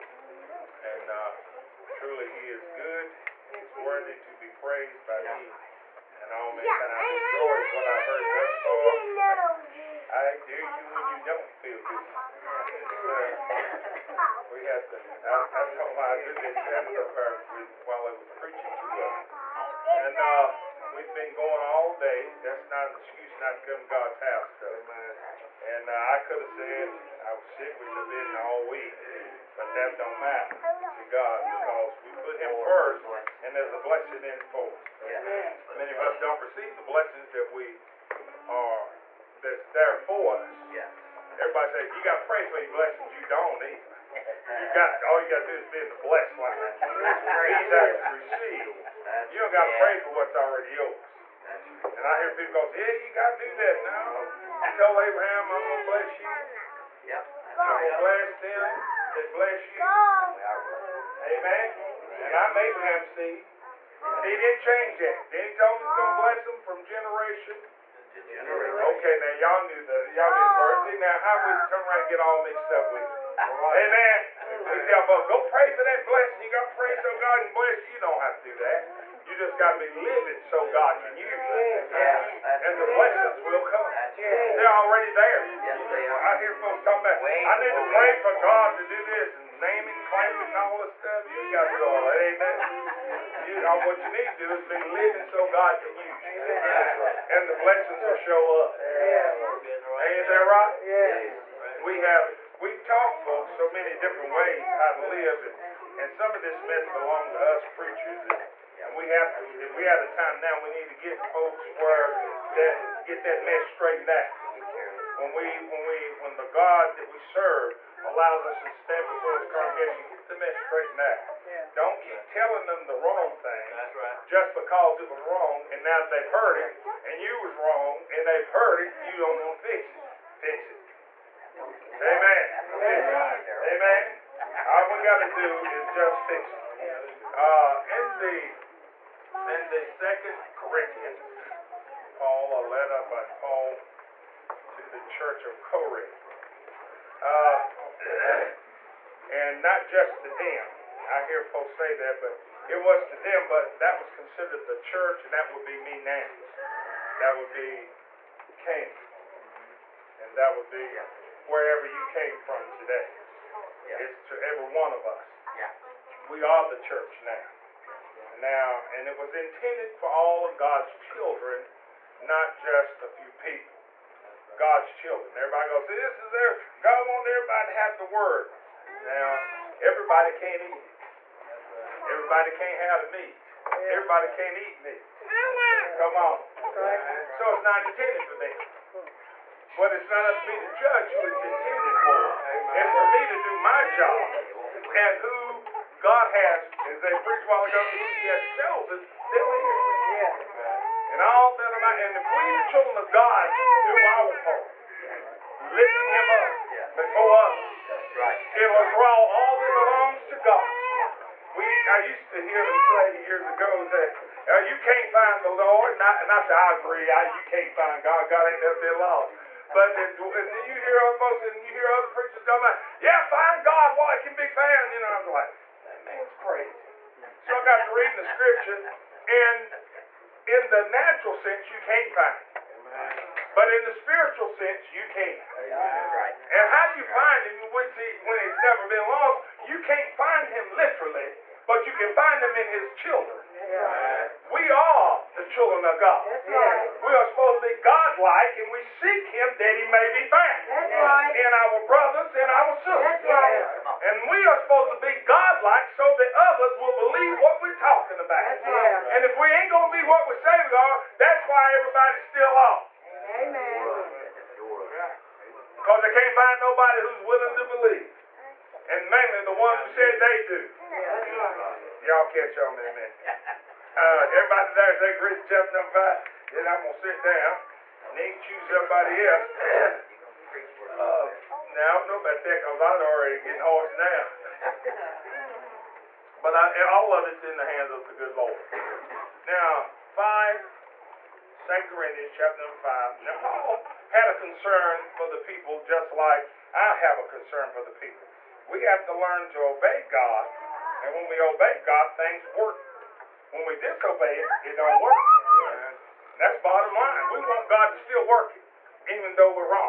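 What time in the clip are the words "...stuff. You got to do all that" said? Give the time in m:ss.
1:30.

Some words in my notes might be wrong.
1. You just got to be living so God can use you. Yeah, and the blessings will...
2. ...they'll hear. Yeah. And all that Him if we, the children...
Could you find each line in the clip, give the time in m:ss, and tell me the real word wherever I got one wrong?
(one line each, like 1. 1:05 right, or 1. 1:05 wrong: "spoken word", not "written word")
1. 1:19 right
2. 3:18 wrong: "And", not "Him".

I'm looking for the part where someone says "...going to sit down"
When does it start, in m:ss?
4:36.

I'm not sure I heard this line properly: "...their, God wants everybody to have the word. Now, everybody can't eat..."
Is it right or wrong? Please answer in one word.
right.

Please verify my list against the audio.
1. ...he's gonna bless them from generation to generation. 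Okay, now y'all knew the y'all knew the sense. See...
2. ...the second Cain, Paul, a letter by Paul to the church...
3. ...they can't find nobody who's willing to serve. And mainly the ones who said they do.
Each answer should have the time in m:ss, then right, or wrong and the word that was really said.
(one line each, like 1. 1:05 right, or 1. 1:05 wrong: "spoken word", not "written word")
1. 1:05 wrong: "verse", not "sense"
2. 2:19 wrong: "Corinthians", not "Cain"
3. 4:26 wrong: "believe", not "serve".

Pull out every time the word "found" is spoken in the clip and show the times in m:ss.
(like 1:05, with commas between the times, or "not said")
3:44, 4:10.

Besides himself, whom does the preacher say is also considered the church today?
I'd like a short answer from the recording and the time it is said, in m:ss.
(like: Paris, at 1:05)
Cain, at 2:38.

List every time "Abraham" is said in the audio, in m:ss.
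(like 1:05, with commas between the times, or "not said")
0:54, 1:02.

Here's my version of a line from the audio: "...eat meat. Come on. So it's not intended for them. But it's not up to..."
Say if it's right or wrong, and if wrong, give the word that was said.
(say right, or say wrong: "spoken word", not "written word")
right.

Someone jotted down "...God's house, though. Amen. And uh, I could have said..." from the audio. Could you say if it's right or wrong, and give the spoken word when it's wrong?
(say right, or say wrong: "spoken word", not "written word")
right.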